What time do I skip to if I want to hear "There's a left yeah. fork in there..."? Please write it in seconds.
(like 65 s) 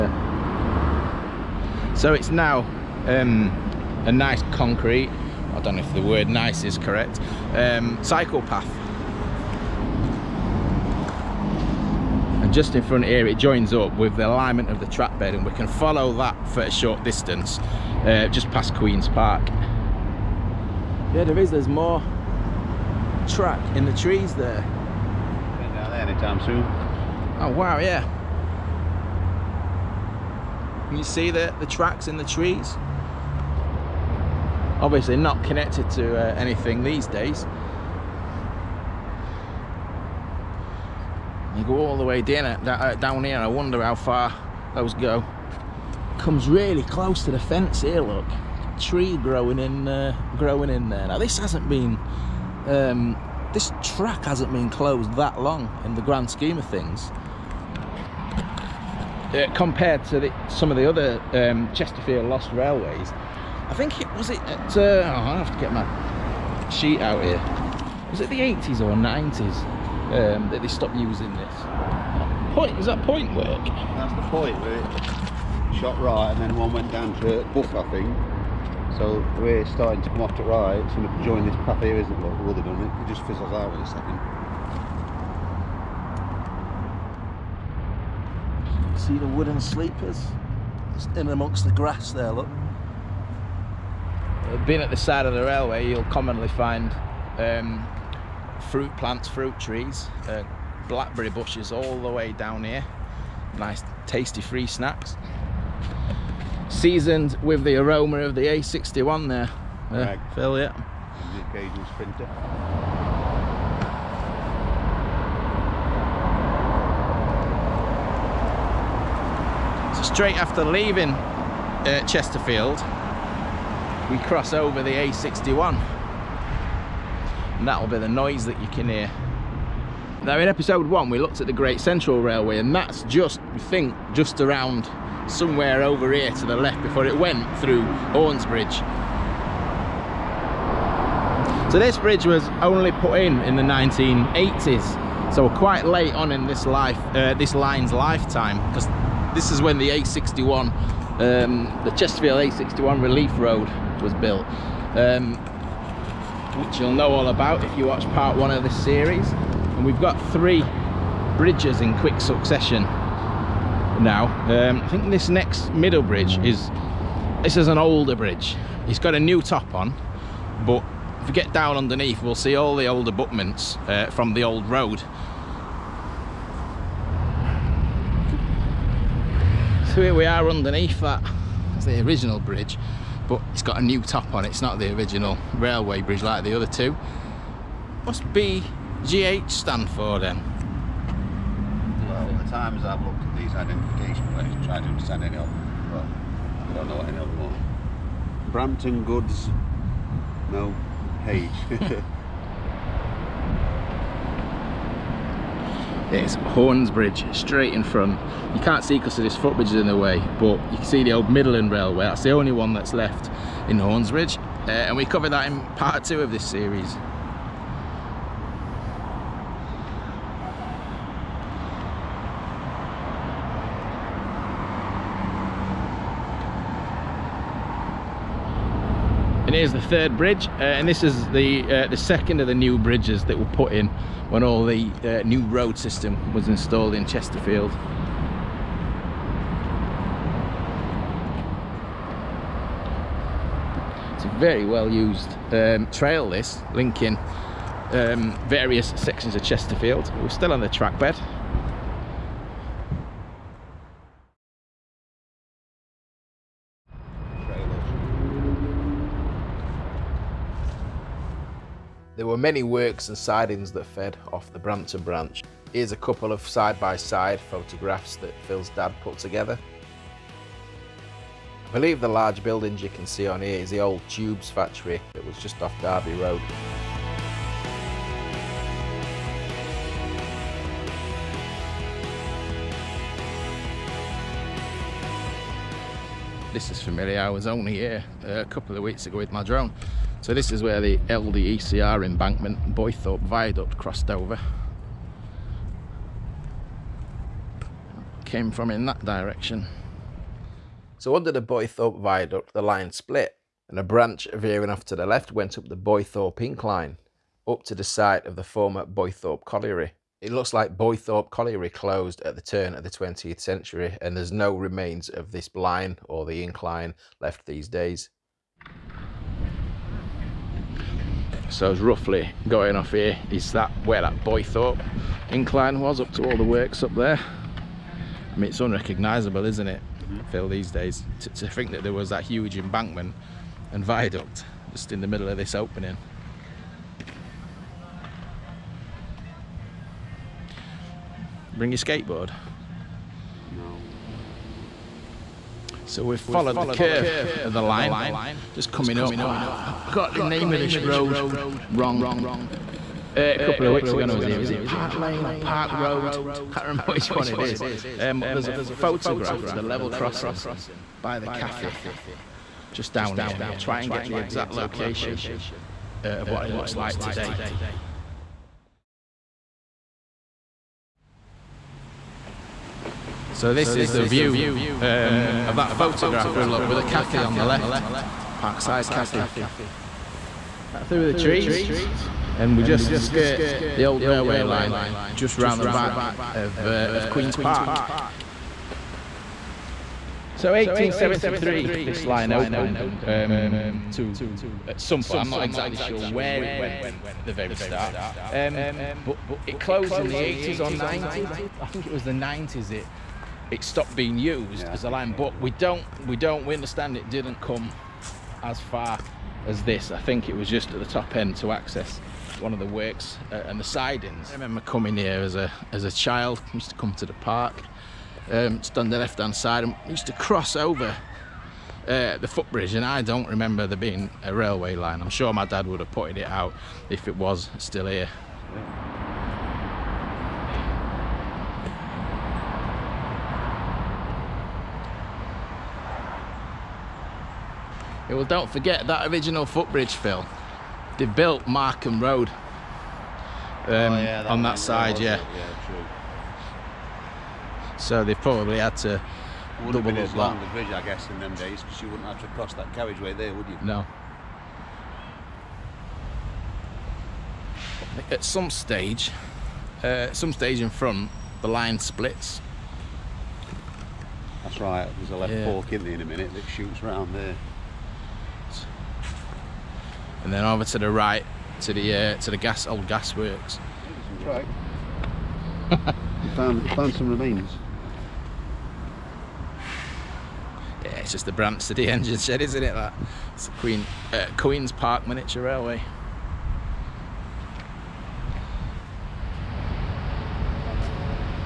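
464 s.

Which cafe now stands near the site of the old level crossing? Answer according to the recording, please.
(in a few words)
Parkside Cafe.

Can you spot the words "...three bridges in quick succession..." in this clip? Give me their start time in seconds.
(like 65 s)
160 s.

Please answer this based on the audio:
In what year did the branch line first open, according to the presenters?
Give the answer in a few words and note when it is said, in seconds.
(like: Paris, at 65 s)
1873, at 390 s.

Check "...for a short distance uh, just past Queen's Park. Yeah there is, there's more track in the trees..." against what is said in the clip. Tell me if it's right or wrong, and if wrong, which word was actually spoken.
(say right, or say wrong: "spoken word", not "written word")
right.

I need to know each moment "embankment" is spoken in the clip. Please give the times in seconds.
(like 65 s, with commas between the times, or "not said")
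292 s, 332 s.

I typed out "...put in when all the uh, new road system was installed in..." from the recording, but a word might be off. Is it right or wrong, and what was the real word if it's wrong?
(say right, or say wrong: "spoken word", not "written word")
right.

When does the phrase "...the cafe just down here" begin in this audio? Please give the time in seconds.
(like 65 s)
361 s.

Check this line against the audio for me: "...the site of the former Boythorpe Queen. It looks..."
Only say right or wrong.
wrong.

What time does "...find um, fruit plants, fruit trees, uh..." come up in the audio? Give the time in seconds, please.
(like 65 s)
96 s.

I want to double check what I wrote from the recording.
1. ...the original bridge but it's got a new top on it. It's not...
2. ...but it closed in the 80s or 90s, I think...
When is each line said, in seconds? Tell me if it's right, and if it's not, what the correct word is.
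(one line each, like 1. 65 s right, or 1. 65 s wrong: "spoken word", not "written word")
1. 181 s right
2. 399 s right.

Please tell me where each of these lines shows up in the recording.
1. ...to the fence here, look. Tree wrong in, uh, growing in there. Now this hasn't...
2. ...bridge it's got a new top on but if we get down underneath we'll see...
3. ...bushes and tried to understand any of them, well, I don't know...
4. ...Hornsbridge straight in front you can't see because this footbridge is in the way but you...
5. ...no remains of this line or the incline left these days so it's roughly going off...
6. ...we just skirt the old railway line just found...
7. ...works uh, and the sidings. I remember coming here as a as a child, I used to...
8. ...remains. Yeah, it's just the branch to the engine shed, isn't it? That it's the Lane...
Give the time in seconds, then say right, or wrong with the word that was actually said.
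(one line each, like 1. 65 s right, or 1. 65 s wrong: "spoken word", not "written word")
1. 47 s wrong: "growing", not "wrong"
2. 168 s right
3. 194 s wrong: "plates", not "bushes"
4. 206 s right
5. 314 s right
6. 382 s wrong: "round", not "found"
7. 412 s right
8. 477 s wrong: "Queen", not "Lane".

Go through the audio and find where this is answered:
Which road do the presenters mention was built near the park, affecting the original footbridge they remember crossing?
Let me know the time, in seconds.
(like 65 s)
441 s.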